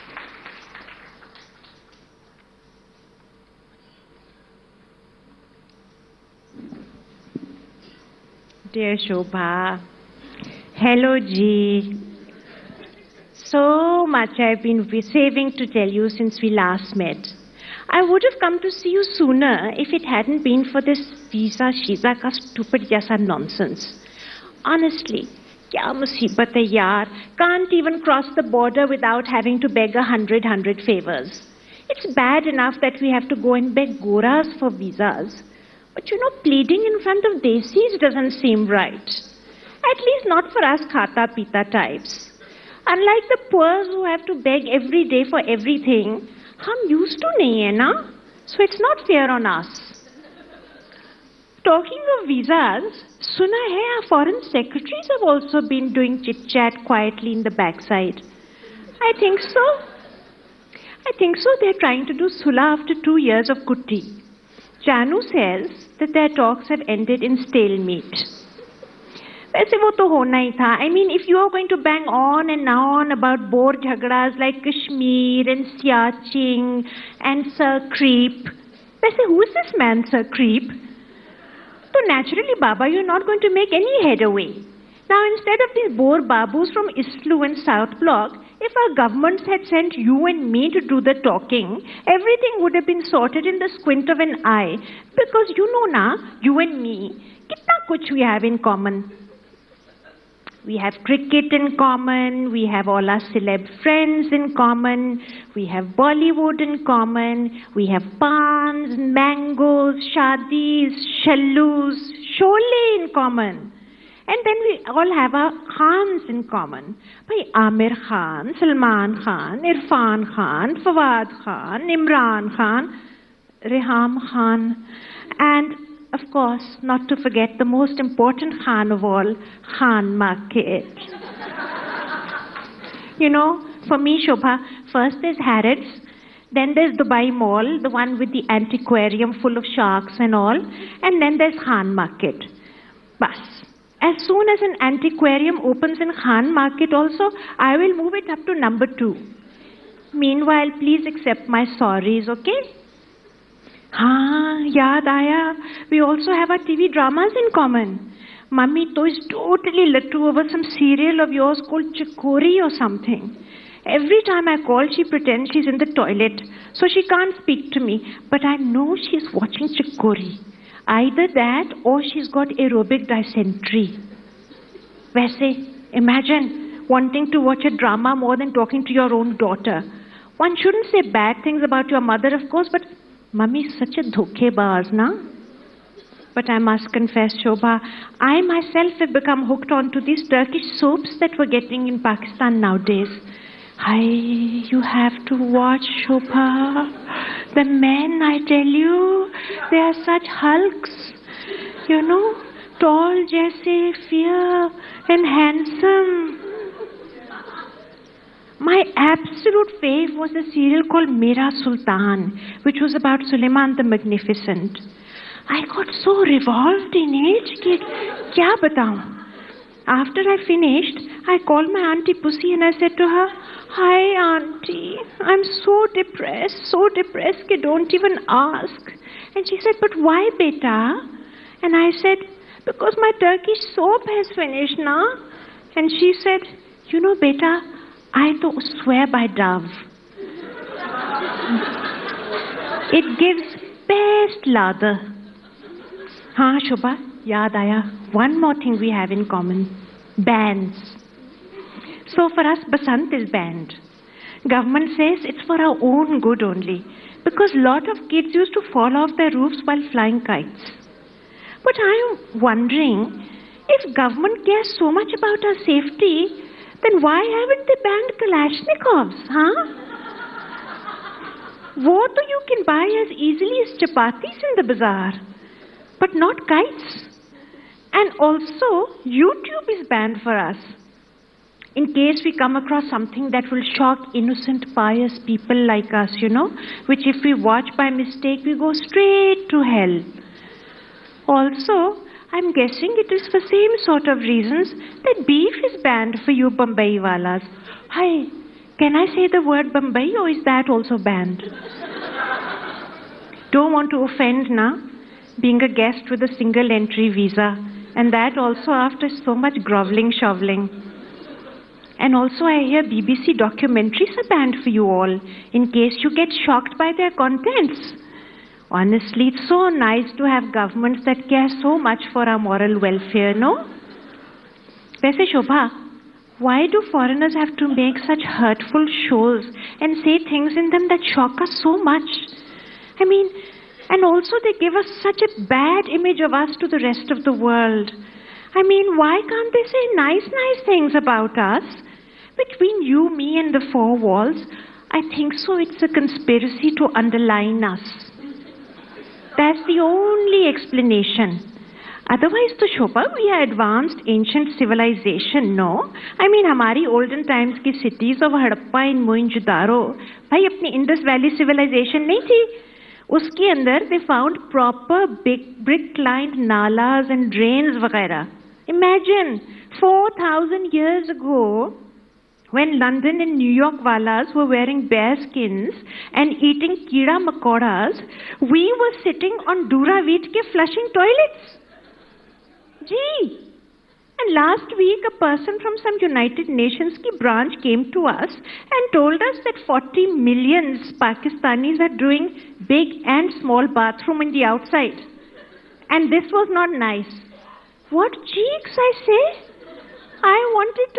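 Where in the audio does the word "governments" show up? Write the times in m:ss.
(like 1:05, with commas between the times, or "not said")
1:28, 4:14, 4:23, 5:20.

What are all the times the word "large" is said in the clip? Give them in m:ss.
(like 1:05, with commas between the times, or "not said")
not said.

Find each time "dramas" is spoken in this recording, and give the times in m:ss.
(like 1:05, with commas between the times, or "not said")
2:36, 2:57.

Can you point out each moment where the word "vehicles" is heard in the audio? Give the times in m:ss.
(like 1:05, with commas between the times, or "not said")
not said.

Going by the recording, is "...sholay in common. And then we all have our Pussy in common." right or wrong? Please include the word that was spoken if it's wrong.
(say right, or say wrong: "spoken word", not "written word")
wrong: "Khans", not "Pussy".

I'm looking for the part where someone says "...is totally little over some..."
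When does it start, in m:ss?
2:39.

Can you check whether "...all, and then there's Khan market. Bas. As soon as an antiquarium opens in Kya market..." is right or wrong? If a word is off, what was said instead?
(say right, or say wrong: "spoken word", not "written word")
wrong: "Khan", not "Kya".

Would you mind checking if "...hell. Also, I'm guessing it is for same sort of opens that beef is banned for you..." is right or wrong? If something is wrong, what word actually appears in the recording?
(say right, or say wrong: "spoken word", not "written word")
wrong: "reasons", not "opens".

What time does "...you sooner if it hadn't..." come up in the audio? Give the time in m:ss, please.
0:18.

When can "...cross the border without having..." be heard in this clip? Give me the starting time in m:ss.
0:28.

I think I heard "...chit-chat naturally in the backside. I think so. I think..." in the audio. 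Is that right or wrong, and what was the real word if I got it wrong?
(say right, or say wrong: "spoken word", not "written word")
wrong: "quietly", not "naturally".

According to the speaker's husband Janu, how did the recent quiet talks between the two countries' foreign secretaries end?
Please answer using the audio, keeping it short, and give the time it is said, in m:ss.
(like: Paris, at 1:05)
In stalemate, at 1:07.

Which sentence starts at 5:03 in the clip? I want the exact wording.
Don't want to offend now, being a guest with a single entry visa and that also after so much groveling shoveling.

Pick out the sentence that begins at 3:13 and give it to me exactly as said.
I, you have to watch, Shobhaa.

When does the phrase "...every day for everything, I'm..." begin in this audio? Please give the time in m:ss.
0:44.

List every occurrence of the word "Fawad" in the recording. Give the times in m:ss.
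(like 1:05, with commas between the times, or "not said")
2:00.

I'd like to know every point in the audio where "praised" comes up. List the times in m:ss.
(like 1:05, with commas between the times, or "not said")
not said.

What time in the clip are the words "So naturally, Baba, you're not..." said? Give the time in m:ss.
1:21.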